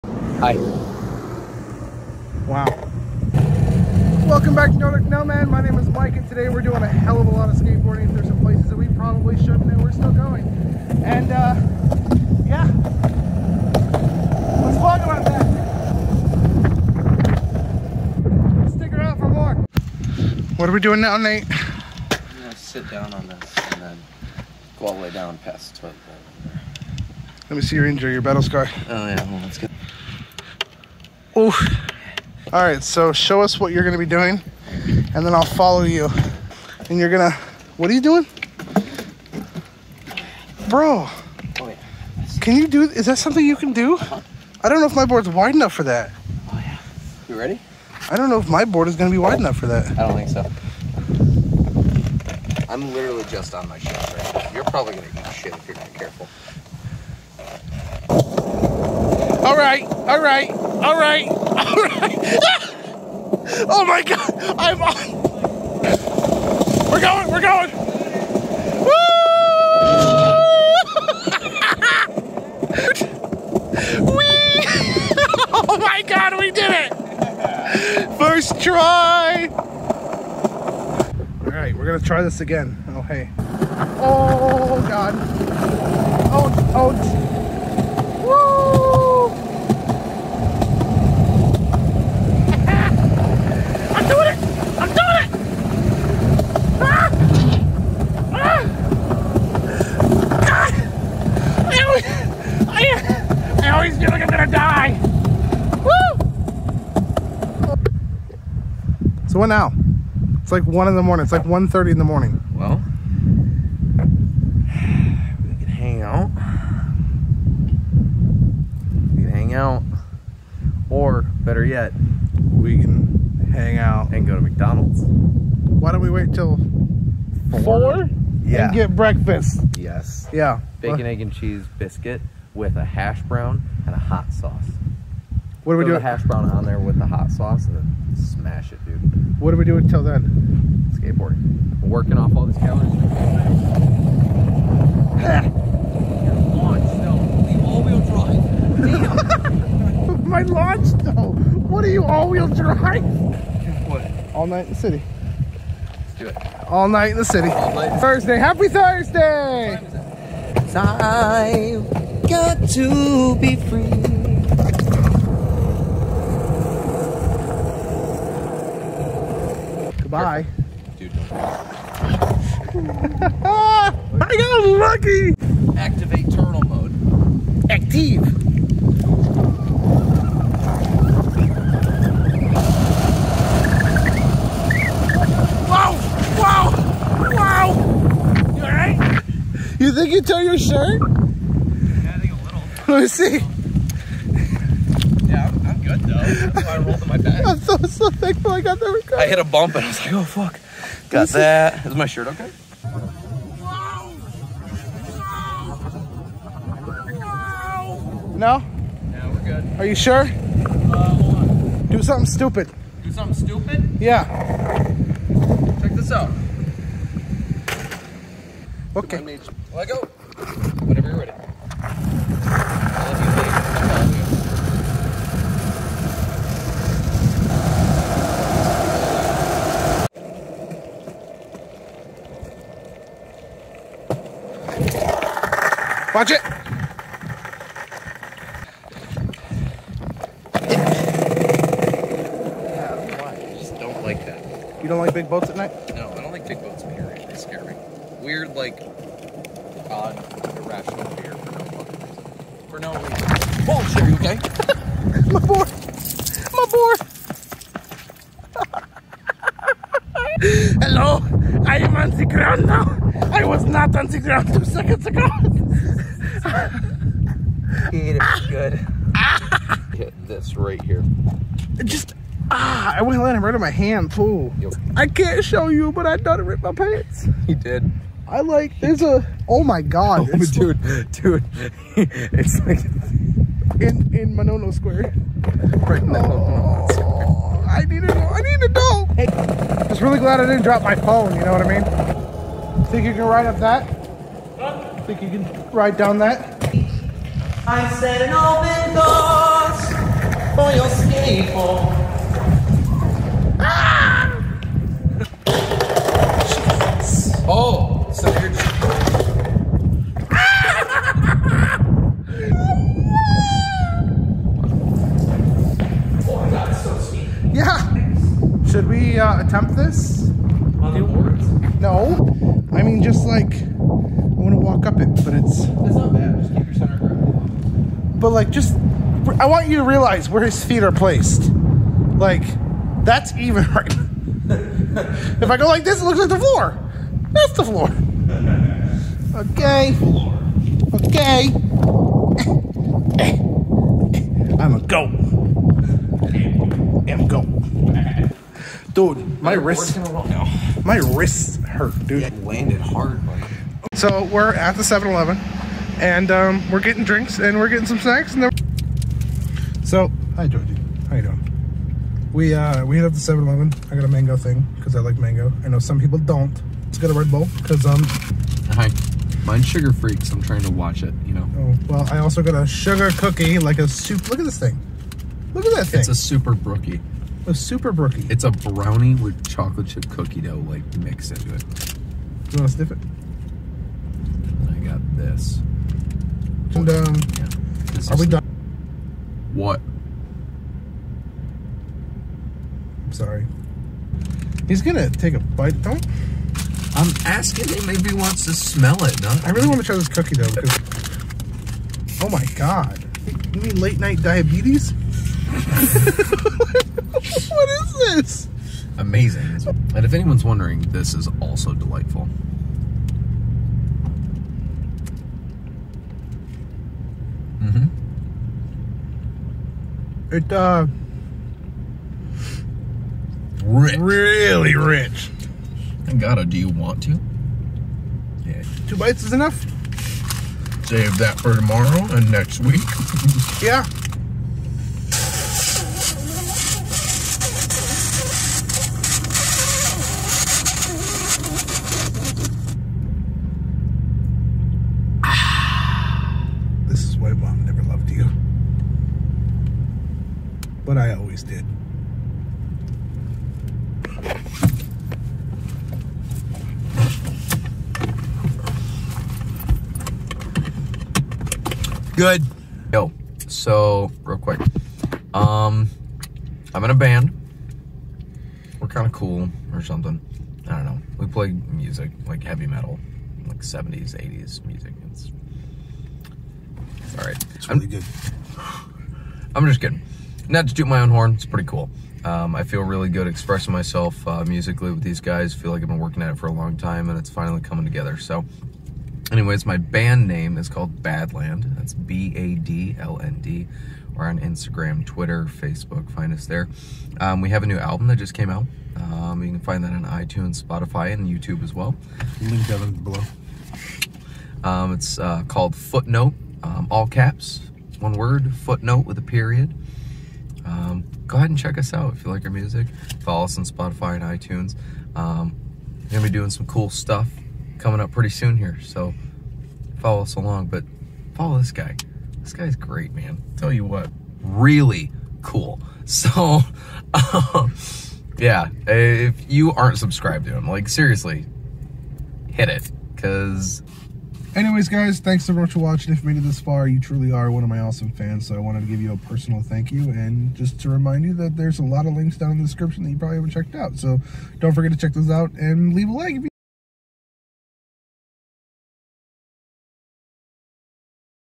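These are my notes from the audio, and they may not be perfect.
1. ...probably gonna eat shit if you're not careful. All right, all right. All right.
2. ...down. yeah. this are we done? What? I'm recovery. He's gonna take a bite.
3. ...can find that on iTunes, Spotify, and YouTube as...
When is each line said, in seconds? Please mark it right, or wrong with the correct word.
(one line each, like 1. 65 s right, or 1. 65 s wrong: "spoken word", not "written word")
1. 54 s right
2. 386 s wrong: "sorry", not "recovery"
3. 499 s right.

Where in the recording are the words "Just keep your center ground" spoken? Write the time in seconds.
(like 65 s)
326 s.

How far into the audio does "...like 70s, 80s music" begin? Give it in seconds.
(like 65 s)
473 s.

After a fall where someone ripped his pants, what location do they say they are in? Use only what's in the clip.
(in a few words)
Manono Square.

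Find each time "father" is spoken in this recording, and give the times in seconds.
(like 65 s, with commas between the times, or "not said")
not said.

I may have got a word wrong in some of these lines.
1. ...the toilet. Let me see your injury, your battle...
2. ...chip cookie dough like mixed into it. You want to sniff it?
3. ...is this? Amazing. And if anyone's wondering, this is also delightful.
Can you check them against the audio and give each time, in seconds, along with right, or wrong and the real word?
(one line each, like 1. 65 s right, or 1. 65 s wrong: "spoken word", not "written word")
1. 25 s right
2. 379 s right
3. 407 s right.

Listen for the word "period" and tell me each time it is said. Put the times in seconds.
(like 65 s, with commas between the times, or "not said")
246 s, 509 s.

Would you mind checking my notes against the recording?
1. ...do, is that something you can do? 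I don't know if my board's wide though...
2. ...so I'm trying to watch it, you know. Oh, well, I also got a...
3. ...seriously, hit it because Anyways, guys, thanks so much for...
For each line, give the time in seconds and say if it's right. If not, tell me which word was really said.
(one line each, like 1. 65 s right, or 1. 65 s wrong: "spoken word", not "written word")
1. 42 s wrong: "enough", not "though"
2. 370 s right
3. 530 s right.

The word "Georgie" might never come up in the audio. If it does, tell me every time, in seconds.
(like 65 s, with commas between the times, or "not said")
360 s.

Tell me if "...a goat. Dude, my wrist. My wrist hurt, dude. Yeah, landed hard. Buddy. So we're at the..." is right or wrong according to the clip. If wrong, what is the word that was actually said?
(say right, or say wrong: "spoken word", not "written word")
right.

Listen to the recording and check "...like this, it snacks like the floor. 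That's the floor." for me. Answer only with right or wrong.
wrong.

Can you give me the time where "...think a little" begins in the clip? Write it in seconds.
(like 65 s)
192 s.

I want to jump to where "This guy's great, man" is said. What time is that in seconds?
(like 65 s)
522 s.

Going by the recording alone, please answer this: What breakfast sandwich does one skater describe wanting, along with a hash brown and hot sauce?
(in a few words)
Bacon, egg, and cheese biscuit.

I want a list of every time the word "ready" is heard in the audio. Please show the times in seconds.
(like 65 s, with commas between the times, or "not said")
47 s, 221 s.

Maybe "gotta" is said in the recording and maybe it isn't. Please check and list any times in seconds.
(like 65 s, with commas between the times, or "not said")
426 s.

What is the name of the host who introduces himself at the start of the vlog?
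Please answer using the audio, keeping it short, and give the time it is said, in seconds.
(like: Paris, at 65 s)
Mike, at 5 s.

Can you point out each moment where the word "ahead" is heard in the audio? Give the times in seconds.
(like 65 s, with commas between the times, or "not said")
511 s.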